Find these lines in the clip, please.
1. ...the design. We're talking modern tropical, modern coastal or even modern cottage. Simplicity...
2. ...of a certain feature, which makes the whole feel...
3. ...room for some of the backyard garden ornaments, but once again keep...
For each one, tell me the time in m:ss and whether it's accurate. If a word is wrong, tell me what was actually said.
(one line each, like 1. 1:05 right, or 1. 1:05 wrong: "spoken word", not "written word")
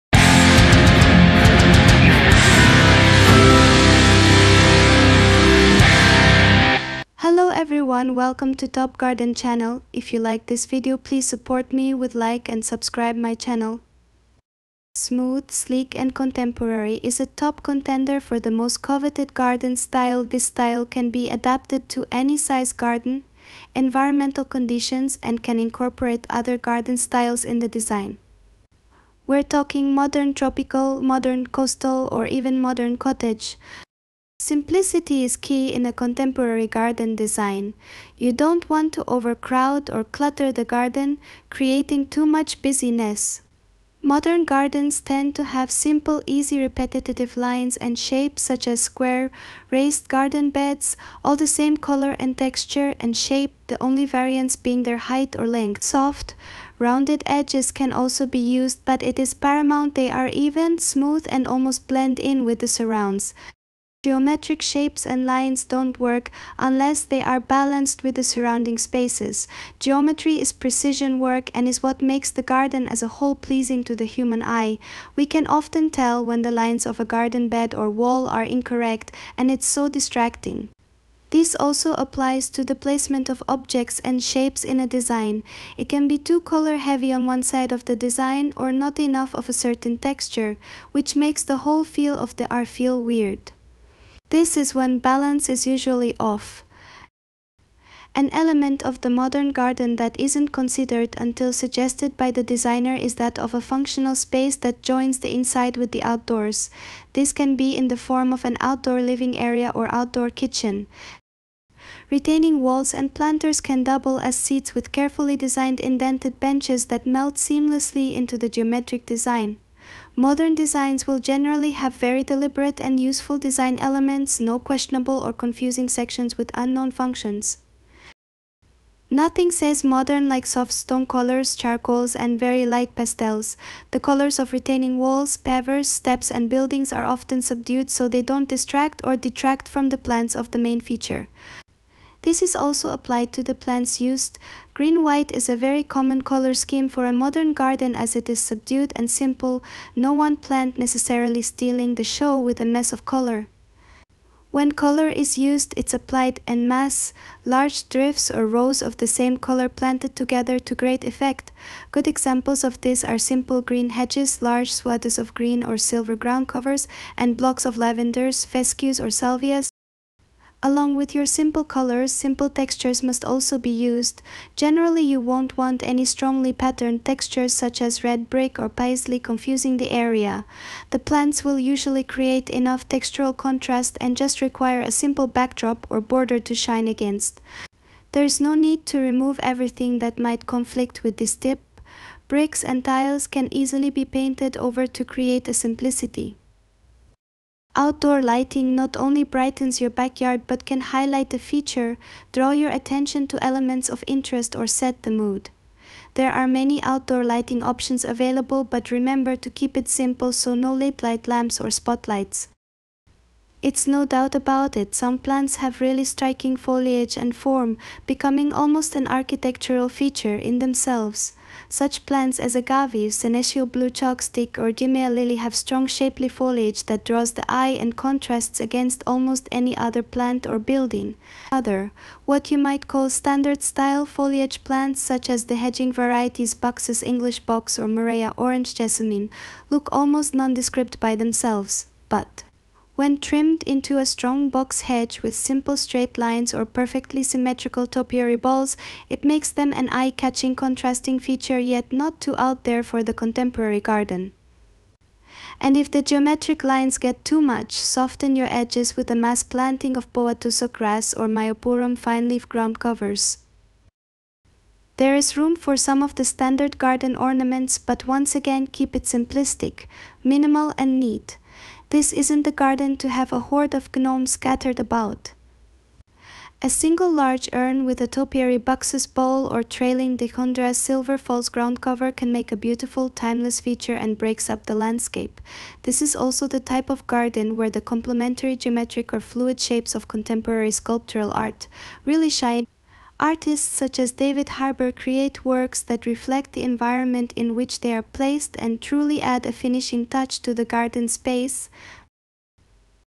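1. 0:27 right
2. 1:29 wrong: "texture", not "feature"
3. 4:25 wrong: "standard", not "backyard".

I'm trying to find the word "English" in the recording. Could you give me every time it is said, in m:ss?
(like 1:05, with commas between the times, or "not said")
3:57.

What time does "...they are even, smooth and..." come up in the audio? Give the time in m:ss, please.
0:59.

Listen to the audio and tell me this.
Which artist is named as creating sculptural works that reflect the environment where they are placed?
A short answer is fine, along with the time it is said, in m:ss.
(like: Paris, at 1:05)
David Harber, at 4:54.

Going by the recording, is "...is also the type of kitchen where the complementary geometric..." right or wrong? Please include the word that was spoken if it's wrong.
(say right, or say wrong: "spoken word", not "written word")
wrong: "garden", not "kitchen".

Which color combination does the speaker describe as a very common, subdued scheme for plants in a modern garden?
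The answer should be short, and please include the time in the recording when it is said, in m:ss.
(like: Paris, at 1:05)
Green-white, at 2:24.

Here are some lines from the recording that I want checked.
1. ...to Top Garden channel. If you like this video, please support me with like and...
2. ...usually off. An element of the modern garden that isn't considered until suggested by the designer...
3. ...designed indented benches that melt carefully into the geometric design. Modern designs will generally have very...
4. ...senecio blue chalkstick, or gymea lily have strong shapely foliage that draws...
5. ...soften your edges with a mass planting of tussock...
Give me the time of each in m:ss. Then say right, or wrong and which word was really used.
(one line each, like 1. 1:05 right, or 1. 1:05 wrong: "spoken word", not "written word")
1. 0:08 right
2. 1:35 right
3. 1:55 wrong: "seamlessly", not "carefully"
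4. 3:43 right
5. 4:17 right.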